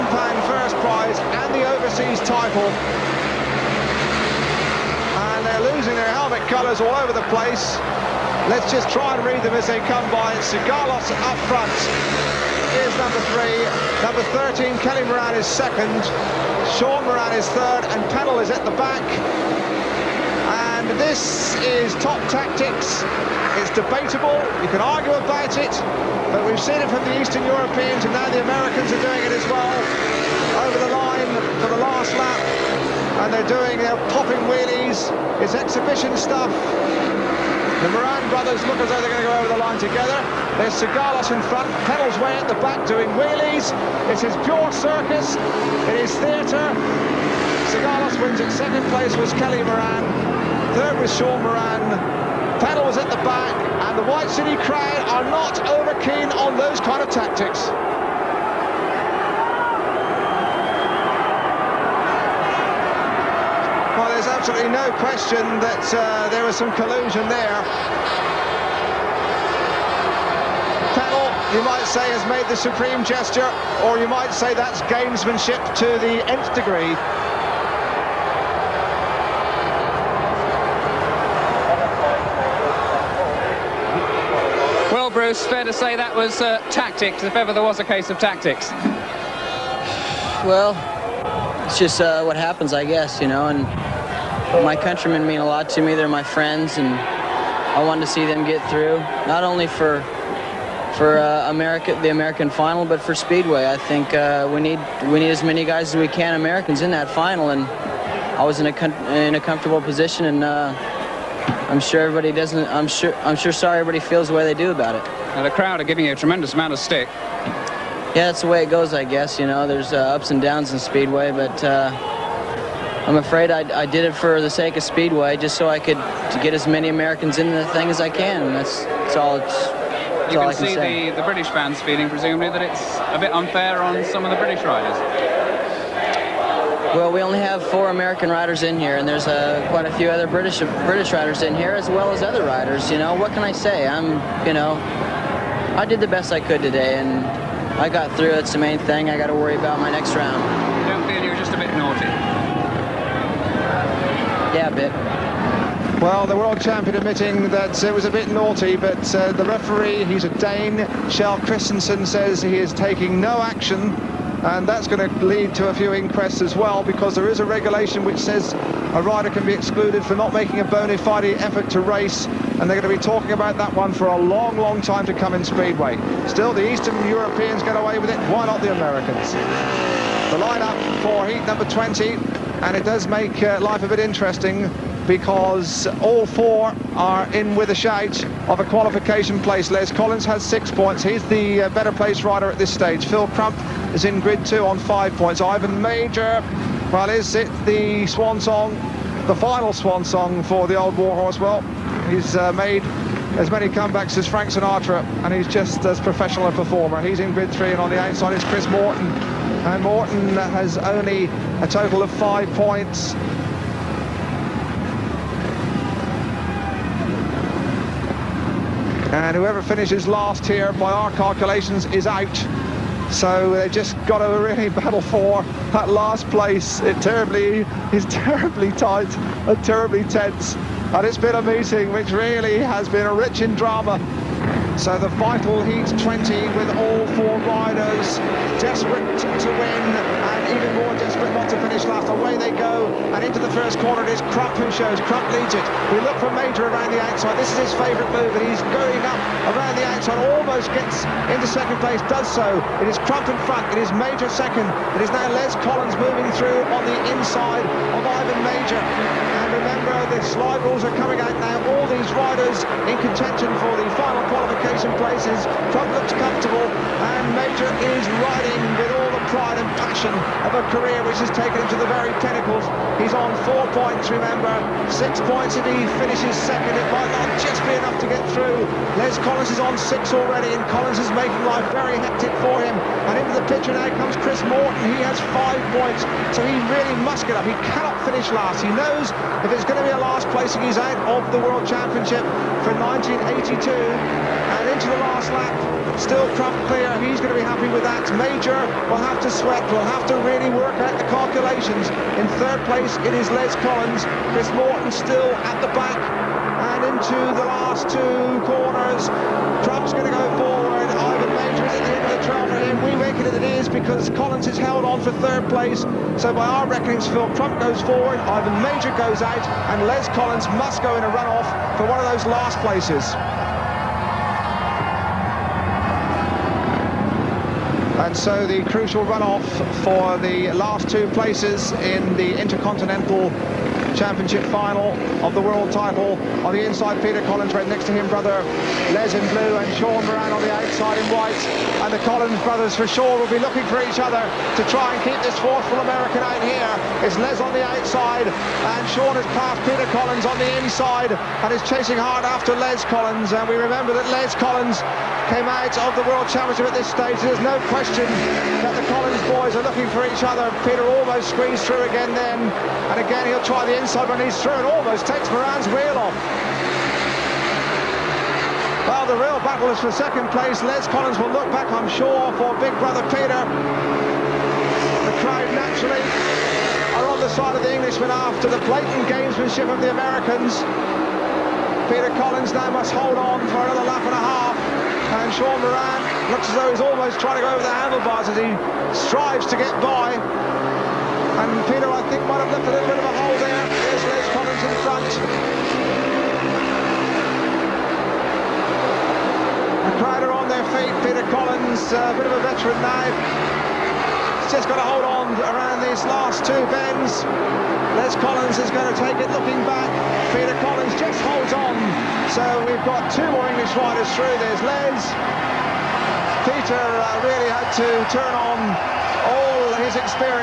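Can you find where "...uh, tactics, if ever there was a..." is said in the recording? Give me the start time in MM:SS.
01:26.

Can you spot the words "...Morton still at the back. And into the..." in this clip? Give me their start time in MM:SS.
05:04.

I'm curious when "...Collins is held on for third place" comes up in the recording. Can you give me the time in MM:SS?
05:14.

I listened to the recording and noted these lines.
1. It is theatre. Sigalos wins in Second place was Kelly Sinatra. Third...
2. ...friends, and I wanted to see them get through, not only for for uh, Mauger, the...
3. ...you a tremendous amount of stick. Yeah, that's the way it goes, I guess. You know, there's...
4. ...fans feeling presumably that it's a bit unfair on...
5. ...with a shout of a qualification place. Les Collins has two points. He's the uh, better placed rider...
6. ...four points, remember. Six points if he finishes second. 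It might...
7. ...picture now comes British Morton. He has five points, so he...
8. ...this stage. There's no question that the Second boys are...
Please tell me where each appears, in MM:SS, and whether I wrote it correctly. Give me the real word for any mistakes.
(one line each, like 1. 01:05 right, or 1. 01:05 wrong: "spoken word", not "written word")
1. 00:45 wrong: "Moran", not "Sinatra"
2. 01:36 wrong: "America", not "Mauger"
3. 01:56 right
4. 02:11 right
5. 03:07 wrong: "six", not "two"
6. 04:33 right
7. 04:43 wrong: "Chris", not "British"
8. 05:56 wrong: "Collins", not "Second".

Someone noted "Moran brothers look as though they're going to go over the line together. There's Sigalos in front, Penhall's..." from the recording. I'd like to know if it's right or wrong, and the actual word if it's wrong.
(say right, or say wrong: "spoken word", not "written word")
right.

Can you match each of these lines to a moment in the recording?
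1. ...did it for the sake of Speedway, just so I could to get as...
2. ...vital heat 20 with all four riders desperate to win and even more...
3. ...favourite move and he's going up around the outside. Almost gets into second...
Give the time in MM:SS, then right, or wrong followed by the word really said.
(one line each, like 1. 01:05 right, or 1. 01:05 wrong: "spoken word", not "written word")
1. 02:03 right
2. 03:55 right
3. 04:07 right.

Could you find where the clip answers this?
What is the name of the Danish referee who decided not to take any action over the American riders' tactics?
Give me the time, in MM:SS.
02:41.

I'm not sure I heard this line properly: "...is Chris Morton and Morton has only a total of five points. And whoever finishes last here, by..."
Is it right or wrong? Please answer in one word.
right.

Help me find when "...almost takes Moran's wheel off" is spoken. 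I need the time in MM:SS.
06:04.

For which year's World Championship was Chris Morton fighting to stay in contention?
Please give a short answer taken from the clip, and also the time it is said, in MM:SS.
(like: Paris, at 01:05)
1982, at 04:52.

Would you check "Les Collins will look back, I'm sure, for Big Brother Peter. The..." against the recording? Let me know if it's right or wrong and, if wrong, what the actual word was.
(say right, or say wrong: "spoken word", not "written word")
right.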